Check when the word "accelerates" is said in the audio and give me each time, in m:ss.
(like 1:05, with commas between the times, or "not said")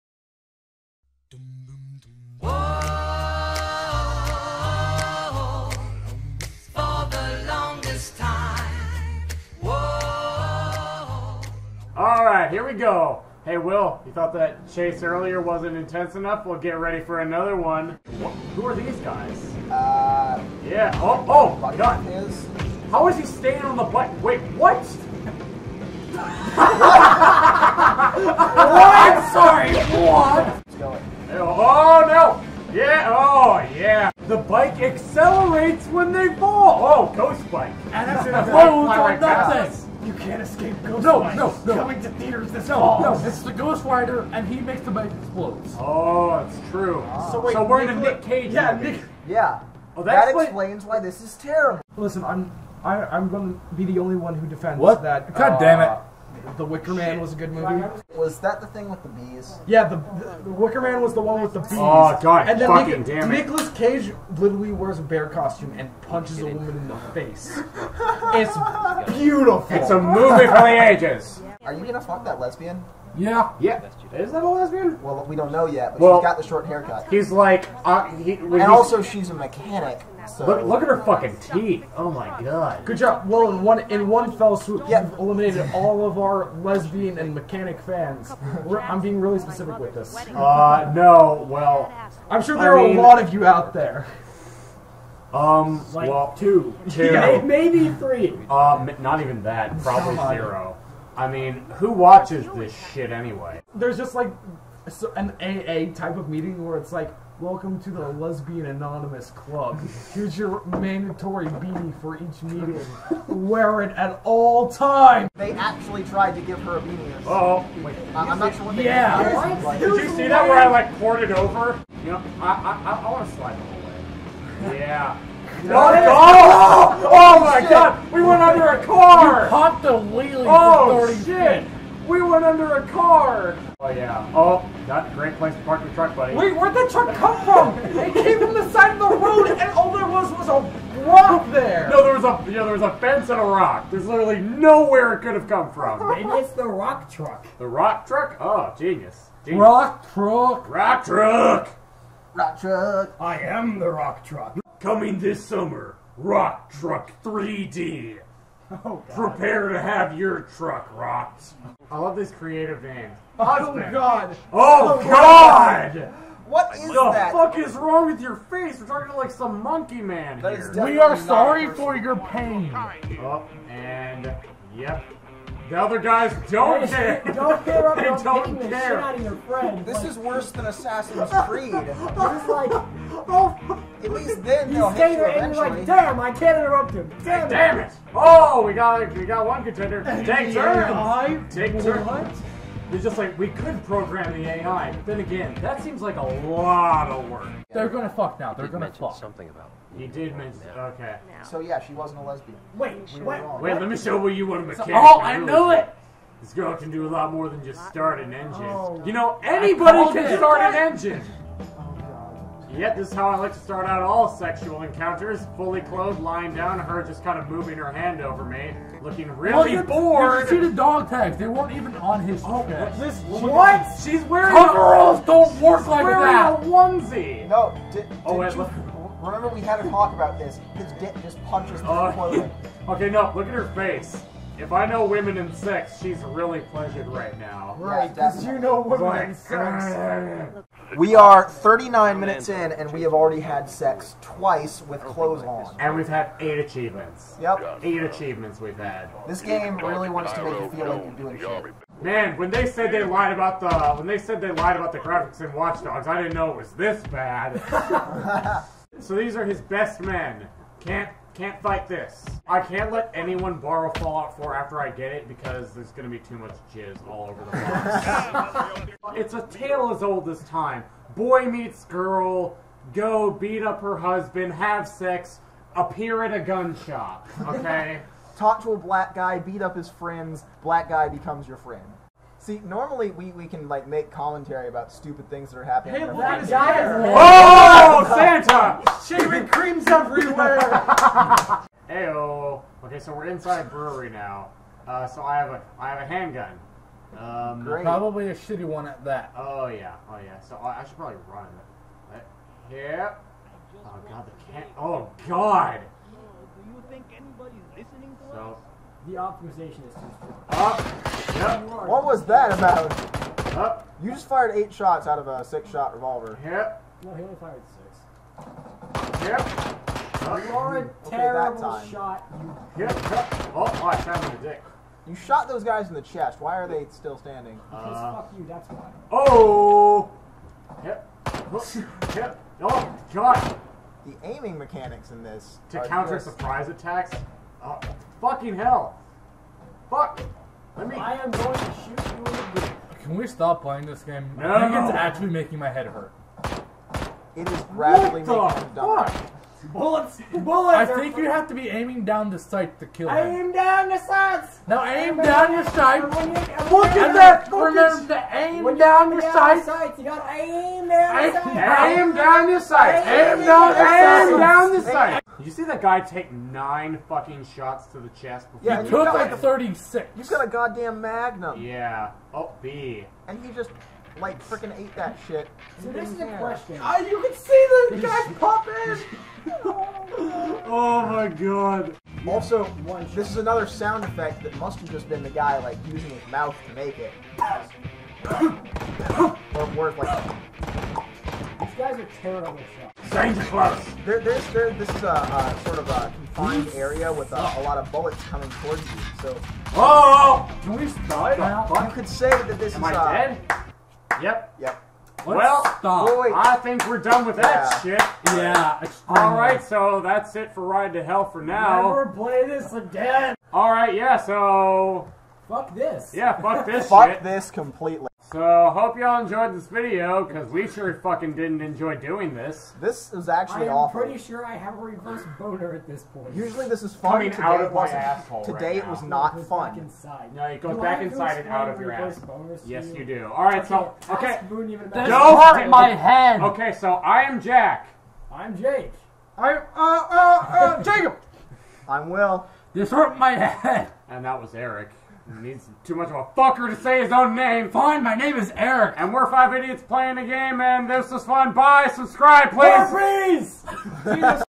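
0:34.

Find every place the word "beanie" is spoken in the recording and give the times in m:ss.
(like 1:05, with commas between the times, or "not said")
1:51, 1:56.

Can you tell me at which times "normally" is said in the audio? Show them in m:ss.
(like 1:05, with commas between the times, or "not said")
4:42.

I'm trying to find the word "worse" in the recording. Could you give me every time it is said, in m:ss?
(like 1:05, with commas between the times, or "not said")
3:00.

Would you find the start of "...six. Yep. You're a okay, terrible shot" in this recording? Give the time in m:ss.
5:17.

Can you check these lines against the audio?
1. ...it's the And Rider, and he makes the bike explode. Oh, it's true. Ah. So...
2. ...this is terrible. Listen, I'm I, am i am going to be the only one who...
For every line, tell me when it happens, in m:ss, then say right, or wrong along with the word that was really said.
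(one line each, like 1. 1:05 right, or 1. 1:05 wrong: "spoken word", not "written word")
1. 0:43 wrong: "Ghost", not "And"
2. 0:50 right.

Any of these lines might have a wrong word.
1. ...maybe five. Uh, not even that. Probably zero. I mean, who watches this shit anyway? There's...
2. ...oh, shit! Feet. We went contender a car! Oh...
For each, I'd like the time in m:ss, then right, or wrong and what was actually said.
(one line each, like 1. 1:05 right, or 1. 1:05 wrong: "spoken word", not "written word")
1. 1:37 wrong: "three", not "five"
2. 2:10 wrong: "under", not "contender".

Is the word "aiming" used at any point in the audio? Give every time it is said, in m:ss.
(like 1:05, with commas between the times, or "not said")
5:34, 5:51.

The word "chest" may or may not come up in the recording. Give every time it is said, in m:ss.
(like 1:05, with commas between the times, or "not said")
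5:26, 6:08.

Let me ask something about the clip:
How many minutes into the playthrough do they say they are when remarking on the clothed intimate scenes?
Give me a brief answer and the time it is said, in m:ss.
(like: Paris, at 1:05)
39, at 4:01.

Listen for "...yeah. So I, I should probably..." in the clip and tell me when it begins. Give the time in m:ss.
5:00.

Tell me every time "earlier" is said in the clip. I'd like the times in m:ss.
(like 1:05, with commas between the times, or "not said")
0:15.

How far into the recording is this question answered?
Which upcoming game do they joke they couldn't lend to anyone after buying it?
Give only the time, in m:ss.
4:23.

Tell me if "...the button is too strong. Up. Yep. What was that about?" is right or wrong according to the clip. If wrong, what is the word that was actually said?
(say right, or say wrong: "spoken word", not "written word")
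wrong: "optimization", not "button".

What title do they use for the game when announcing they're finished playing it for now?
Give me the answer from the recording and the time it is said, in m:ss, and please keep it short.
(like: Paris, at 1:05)
Ride to Hell, at 6:50.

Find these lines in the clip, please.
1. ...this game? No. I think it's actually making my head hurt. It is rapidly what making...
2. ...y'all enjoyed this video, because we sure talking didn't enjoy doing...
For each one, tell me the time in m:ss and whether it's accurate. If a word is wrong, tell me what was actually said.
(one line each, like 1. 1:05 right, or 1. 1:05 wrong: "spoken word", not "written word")
1. 5:43 right
2. 6:58 wrong: "fucking", not "talking".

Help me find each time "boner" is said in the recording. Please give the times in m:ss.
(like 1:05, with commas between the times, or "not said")
7:05.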